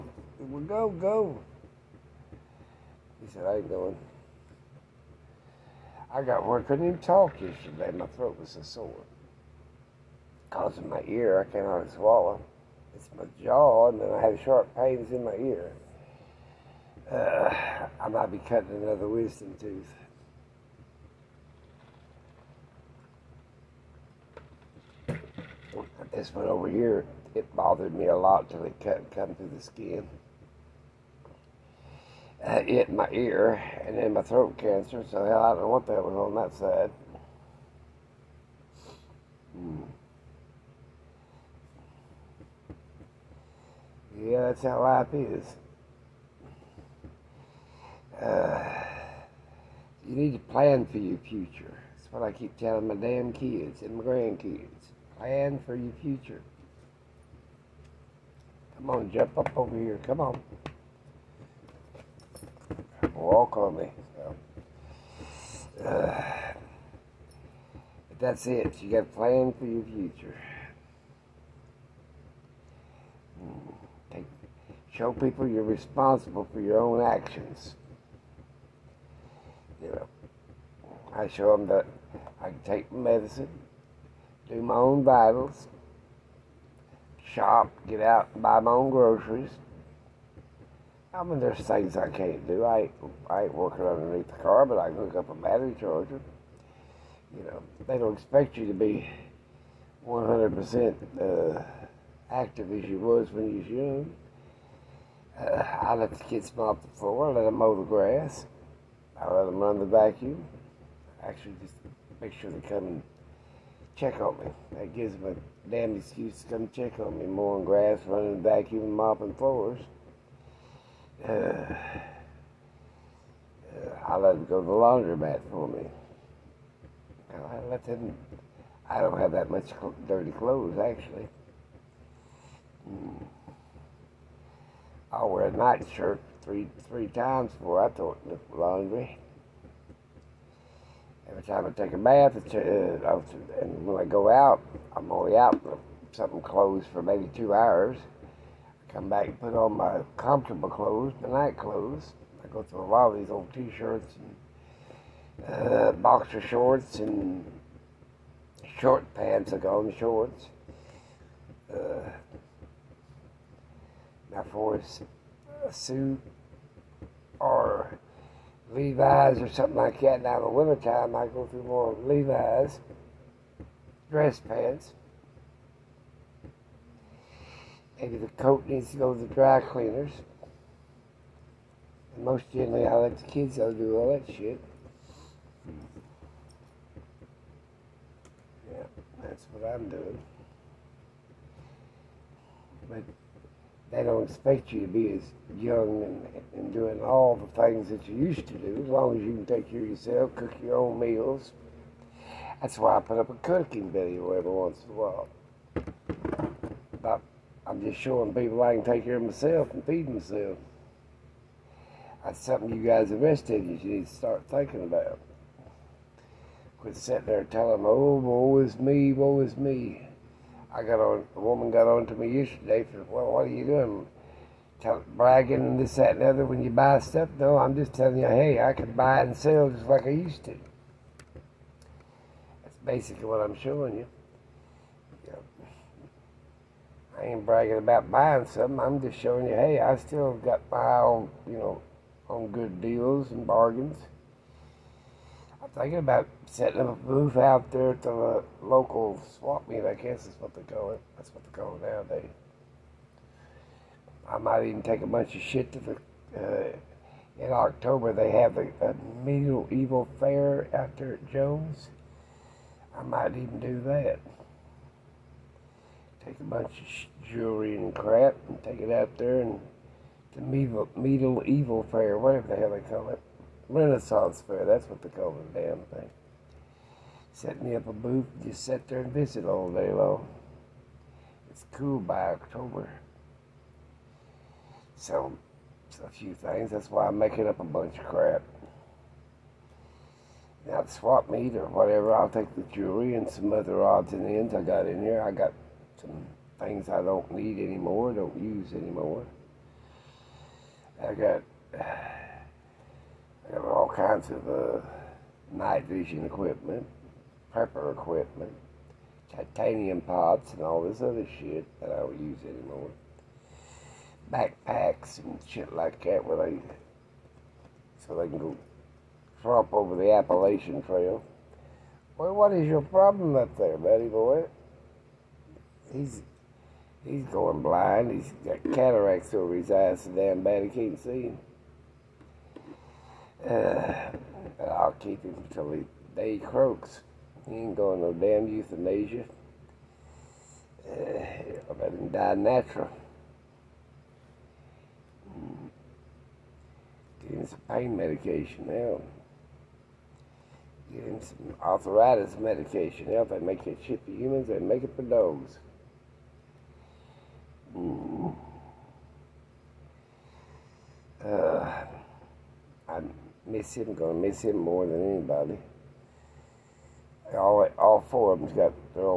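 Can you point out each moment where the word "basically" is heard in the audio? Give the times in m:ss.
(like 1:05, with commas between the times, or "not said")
3:52.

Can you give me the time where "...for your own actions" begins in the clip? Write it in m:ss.
1:16.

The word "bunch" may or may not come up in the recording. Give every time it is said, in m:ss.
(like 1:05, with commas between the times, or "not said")
4:15, 4:26, 4:47.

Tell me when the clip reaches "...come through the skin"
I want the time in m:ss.
0:29.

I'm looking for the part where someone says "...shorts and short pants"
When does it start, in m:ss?
2:36.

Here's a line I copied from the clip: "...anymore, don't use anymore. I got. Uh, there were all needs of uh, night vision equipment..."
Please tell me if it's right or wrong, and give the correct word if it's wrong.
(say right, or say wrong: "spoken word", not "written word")
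wrong: "kinds", not "needs".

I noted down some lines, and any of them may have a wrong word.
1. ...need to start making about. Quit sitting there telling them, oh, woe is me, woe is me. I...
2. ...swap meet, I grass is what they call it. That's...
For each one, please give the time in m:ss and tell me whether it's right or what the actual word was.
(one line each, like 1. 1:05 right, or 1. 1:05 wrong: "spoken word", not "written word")
1. 3:33 wrong: "thinking", not "making"
2. 4:09 wrong: "guess", not "grass".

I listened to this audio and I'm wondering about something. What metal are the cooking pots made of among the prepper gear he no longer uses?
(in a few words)
Titanium.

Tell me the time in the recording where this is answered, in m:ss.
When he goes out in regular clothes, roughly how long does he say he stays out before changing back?
2:27.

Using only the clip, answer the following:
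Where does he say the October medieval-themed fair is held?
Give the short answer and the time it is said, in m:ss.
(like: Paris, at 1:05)
Jones, at 4:21.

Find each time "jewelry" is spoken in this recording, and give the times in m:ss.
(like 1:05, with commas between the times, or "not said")
4:27, 4:52.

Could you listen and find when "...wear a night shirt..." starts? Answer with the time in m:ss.
2:15.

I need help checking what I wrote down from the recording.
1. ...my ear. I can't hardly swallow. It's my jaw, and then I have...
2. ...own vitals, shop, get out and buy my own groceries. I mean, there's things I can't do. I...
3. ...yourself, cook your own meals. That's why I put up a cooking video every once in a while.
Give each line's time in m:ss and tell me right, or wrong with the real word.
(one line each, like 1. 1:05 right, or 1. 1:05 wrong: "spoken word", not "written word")
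1. 0:10 right
2. 1:24 right
3. 3:19 right.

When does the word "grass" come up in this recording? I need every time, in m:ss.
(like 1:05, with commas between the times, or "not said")
1:47, 1:57.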